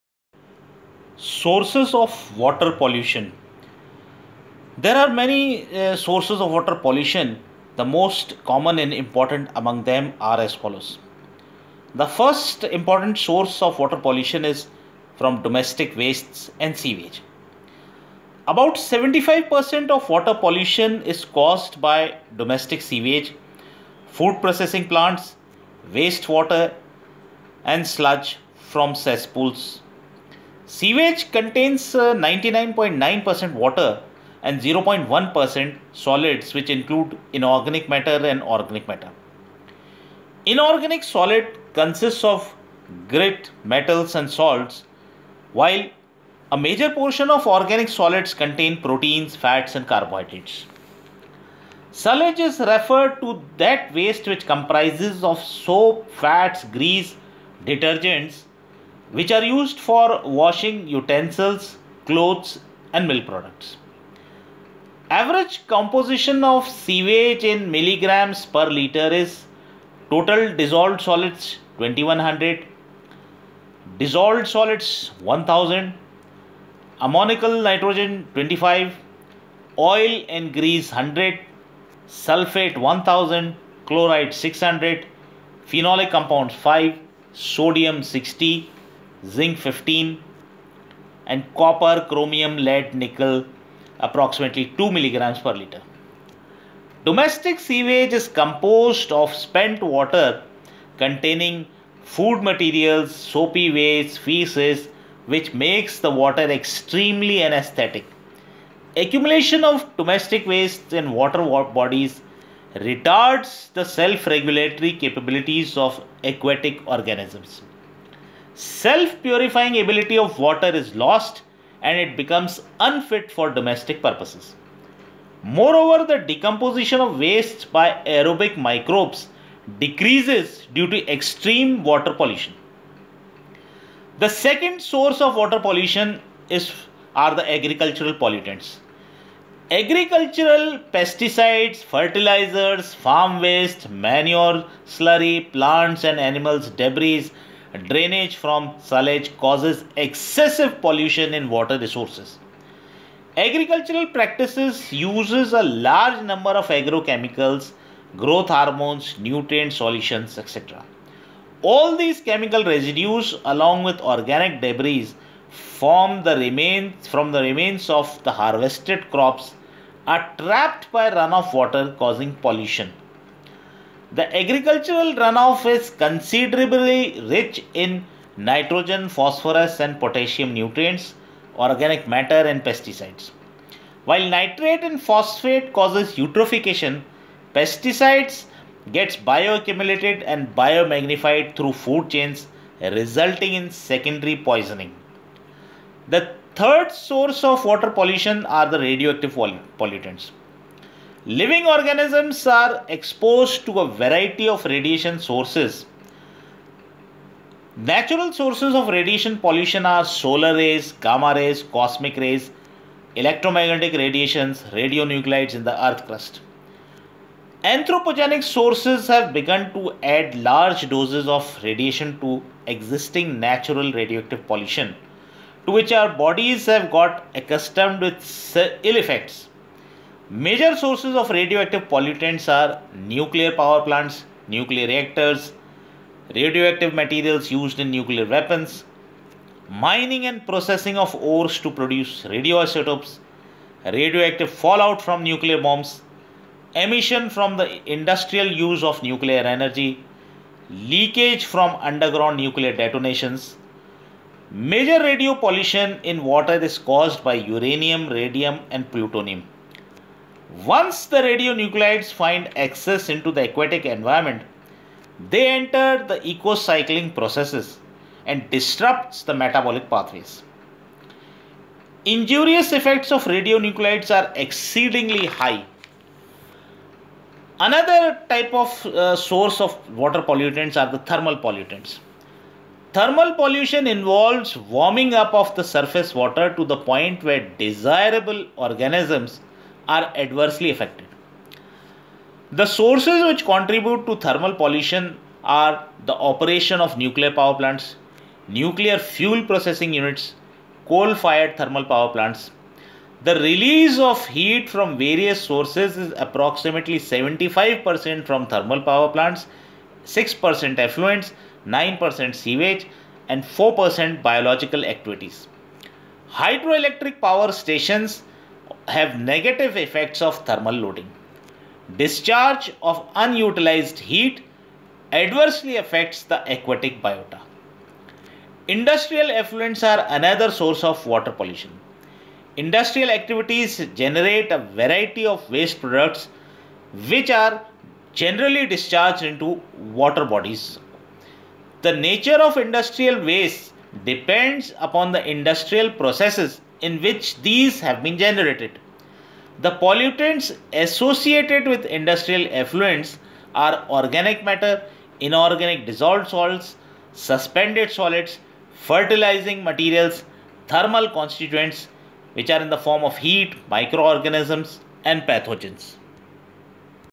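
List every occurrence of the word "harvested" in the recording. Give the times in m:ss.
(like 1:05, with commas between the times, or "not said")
2:48.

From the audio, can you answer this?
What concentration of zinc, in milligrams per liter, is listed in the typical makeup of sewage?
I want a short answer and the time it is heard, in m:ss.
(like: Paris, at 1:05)
15, at 1:29.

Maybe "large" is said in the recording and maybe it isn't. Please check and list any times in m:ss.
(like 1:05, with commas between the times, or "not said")
2:35, 3:40.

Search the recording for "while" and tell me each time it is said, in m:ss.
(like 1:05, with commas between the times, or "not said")
0:45, 3:04.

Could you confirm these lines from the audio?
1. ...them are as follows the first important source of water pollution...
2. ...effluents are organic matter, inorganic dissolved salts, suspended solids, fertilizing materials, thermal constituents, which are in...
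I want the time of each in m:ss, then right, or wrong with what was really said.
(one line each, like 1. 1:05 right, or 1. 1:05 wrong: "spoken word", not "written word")
1. 0:09 right
2. 5:52 right.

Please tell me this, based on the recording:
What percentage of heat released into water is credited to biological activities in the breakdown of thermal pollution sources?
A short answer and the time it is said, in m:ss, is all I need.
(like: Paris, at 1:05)
4%, at 5:13.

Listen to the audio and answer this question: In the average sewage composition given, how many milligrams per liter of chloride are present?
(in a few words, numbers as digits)
600.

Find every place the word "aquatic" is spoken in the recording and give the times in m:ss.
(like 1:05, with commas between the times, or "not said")
1:56, 4:23, 5:26.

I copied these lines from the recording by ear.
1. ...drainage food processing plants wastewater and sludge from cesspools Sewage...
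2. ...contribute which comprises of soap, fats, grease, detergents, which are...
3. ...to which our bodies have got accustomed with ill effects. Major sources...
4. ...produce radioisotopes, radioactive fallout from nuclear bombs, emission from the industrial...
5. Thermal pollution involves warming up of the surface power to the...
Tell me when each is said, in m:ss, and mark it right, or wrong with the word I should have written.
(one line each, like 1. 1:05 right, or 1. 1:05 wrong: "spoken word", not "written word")
1. 0:22 wrong: "sewage", not "drainage"
2. 0:53 wrong: "waste", not "contribute"
3. 3:45 right
4. 4:01 right
5. 4:42 wrong: "water", not "power".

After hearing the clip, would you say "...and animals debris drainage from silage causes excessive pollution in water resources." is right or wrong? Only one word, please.
right.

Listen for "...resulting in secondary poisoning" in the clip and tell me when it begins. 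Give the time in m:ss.
3:12.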